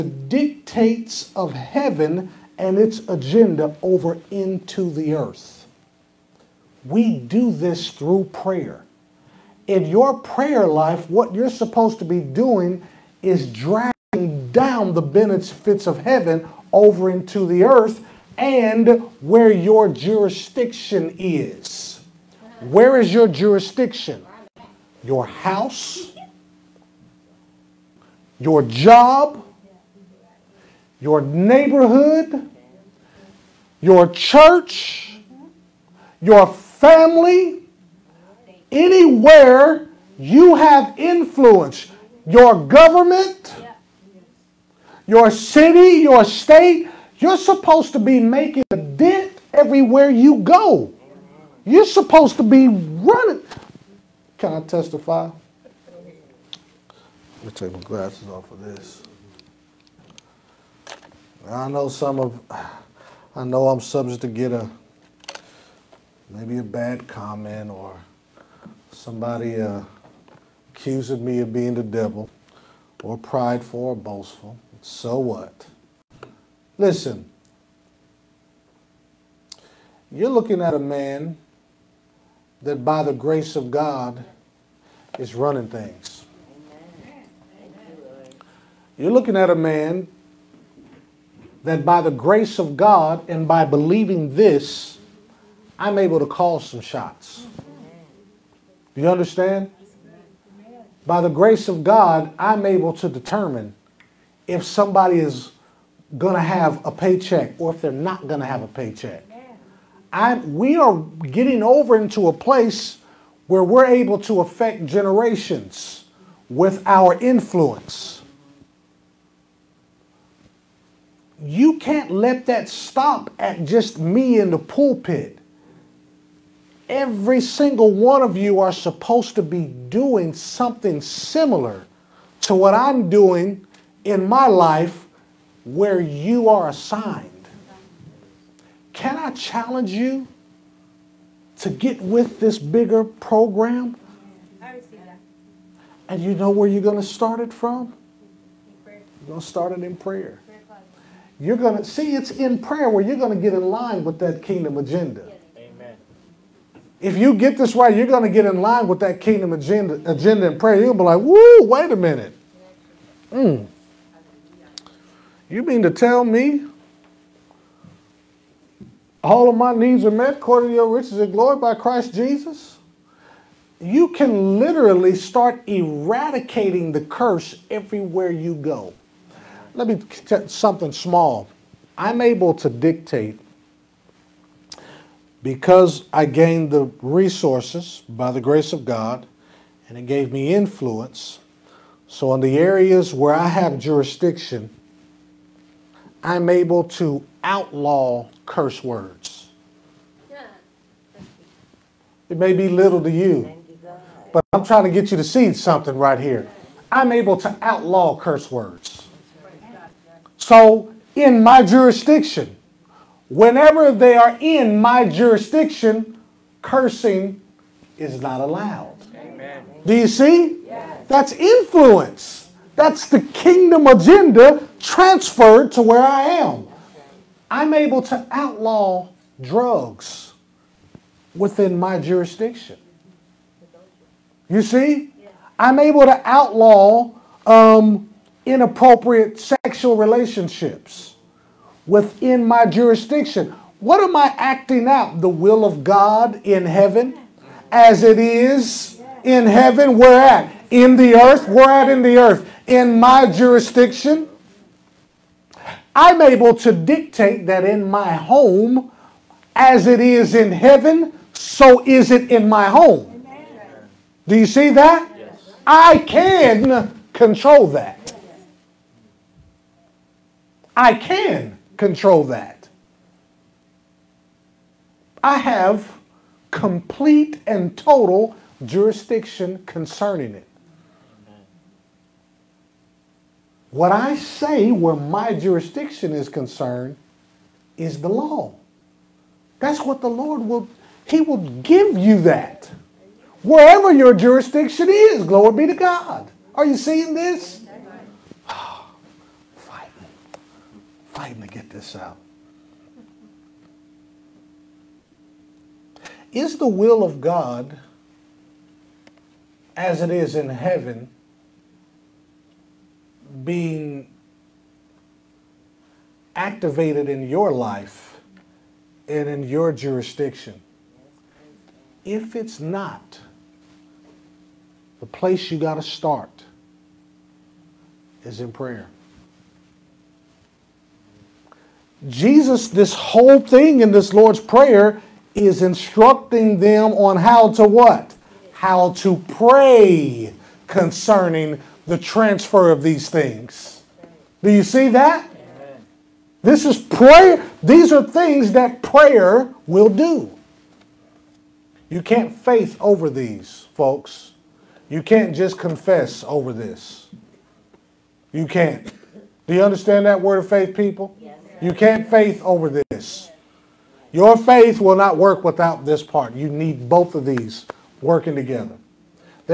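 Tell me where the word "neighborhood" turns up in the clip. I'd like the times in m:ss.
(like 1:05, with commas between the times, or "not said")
0:31.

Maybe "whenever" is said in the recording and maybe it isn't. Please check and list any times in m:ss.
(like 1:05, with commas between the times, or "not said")
3:33.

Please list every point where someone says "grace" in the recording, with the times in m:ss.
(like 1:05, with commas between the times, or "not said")
1:23, 1:32, 1:41, 3:08.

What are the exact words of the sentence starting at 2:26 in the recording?
And you know where you're going to start it from?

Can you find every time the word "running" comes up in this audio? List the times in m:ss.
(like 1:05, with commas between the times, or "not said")
0:52, 1:25.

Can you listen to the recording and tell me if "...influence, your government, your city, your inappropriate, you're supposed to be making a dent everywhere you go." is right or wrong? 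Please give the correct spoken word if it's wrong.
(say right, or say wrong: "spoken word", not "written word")
wrong: "state", not "inappropriate".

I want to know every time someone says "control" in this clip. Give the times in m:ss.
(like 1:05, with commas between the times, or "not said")
4:27, 4:31.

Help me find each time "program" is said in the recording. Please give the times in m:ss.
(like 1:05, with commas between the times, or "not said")
2:23.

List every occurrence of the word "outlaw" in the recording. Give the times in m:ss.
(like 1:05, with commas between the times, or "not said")
3:17, 3:27, 3:48, 3:56.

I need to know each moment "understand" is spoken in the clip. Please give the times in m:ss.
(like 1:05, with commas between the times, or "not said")
1:39, 5:59.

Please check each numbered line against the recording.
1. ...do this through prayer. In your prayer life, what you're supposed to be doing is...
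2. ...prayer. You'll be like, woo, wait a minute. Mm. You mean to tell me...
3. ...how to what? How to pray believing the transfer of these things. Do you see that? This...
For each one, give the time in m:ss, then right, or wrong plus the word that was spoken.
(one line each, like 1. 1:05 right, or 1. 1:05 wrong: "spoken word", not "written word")
1. 0:07 right
2. 2:40 right
3. 5:37 wrong: "concerning", not "believing".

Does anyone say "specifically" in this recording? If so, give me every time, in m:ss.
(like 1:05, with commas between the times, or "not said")
not said.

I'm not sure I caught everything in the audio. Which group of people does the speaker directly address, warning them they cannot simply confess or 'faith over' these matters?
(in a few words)
Word of faith people.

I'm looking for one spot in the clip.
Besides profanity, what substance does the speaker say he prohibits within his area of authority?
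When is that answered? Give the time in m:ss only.
3:49.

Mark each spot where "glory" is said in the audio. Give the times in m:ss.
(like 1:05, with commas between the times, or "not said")
2:51, 4:55.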